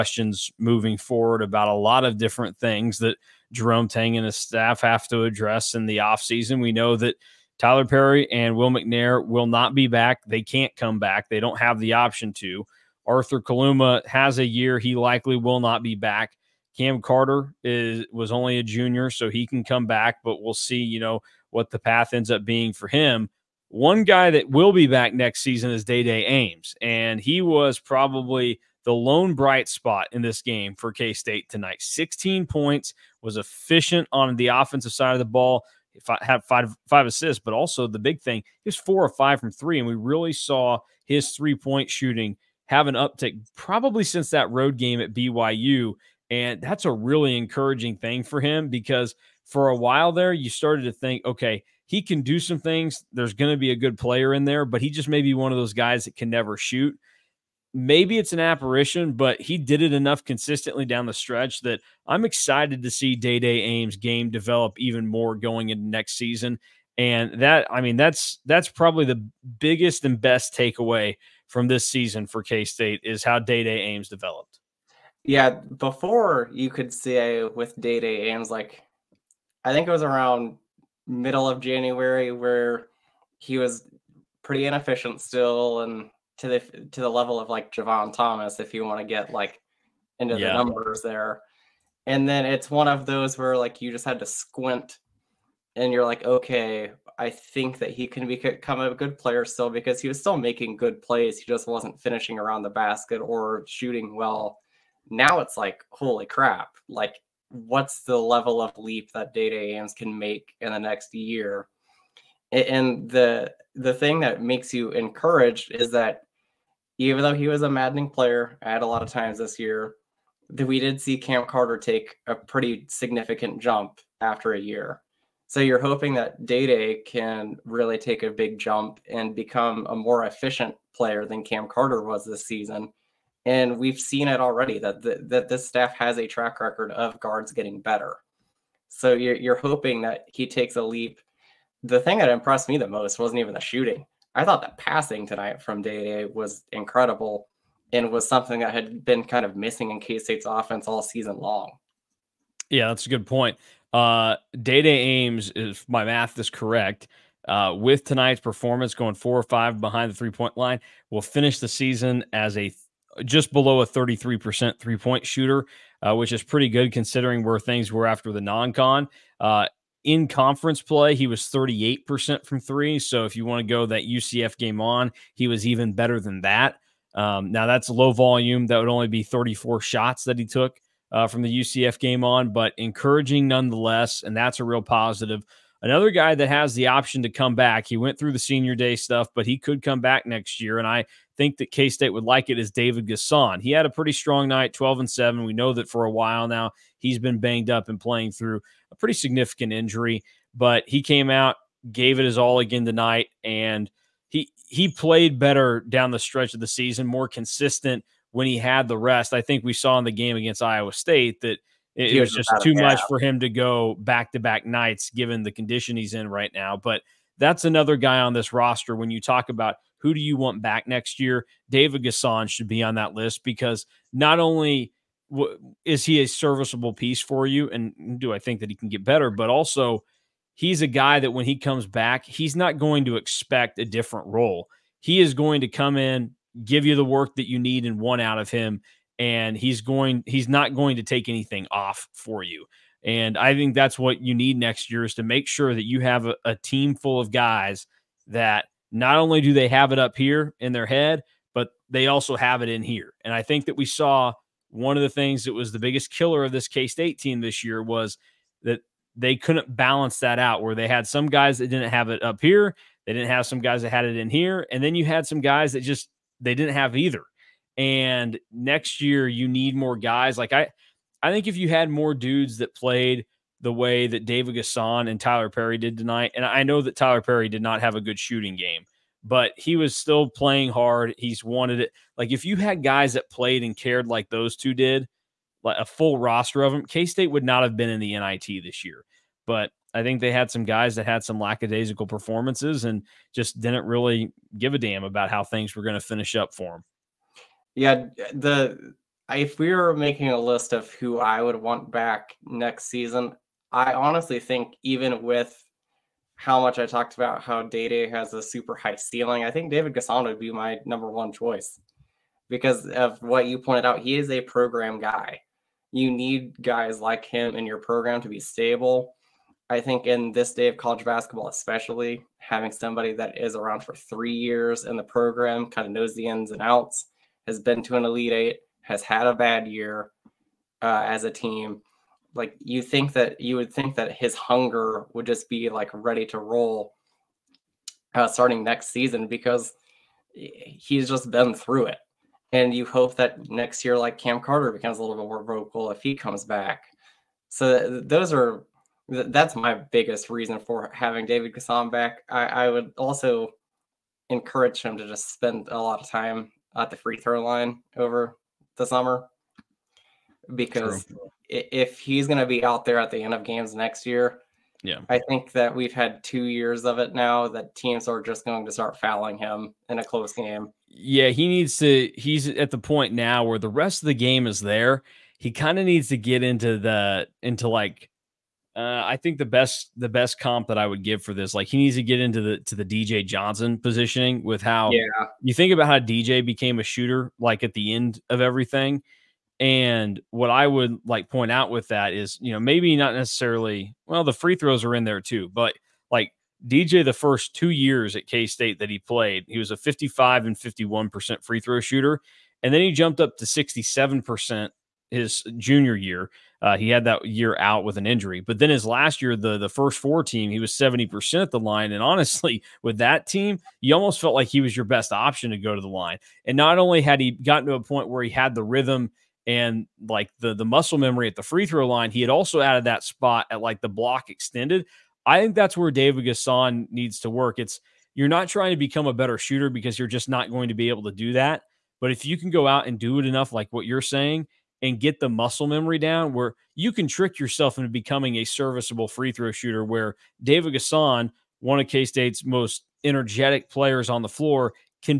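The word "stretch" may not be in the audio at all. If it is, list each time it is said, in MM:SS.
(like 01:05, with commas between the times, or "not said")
01:01, 03:26.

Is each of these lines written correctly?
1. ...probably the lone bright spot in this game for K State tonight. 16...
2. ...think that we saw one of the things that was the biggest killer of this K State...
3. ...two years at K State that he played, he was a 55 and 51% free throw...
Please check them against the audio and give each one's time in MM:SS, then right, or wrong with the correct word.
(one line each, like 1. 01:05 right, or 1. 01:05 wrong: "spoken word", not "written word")
1. 00:27 right
2. 04:13 right
3. 06:37 right.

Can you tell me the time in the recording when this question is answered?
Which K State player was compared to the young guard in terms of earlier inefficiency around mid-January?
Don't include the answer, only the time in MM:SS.
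01:27.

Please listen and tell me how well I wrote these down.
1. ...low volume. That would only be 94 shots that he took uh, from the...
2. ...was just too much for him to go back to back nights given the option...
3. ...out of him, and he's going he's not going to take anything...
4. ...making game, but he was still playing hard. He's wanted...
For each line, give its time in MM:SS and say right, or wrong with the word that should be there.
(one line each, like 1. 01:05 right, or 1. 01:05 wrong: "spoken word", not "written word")
1. 02:57 wrong: "34", not "94"
2. 03:32 wrong: "condition", not "option"
3. 03:58 right
4. 04:38 wrong: "shooting", not "making".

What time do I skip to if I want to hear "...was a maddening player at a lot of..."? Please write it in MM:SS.
01:57.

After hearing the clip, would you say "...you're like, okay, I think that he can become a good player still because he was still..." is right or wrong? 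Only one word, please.
right.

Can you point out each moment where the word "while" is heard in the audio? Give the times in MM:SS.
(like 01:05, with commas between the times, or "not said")
00:49, 03:16.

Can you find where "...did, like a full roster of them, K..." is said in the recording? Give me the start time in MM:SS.
04:44.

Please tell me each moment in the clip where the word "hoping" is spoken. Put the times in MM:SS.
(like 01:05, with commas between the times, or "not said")
02:05, 02:19.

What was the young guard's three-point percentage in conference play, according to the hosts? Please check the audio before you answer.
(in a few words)
38%.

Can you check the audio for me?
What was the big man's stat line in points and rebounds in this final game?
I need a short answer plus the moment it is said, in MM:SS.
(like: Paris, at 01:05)
12 and 7, at 03:14.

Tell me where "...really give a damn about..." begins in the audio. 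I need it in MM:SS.
04:53.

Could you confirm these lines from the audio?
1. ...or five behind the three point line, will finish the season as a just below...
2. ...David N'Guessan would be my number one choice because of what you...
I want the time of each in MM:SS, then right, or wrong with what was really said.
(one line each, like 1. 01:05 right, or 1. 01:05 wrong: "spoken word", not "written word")
1. 02:39 right
2. 05:09 right.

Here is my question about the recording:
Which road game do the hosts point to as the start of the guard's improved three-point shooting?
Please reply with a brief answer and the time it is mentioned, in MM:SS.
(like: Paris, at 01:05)
BYU, at 00:45.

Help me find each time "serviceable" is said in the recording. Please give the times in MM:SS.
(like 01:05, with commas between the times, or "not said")
03:46, 07:18.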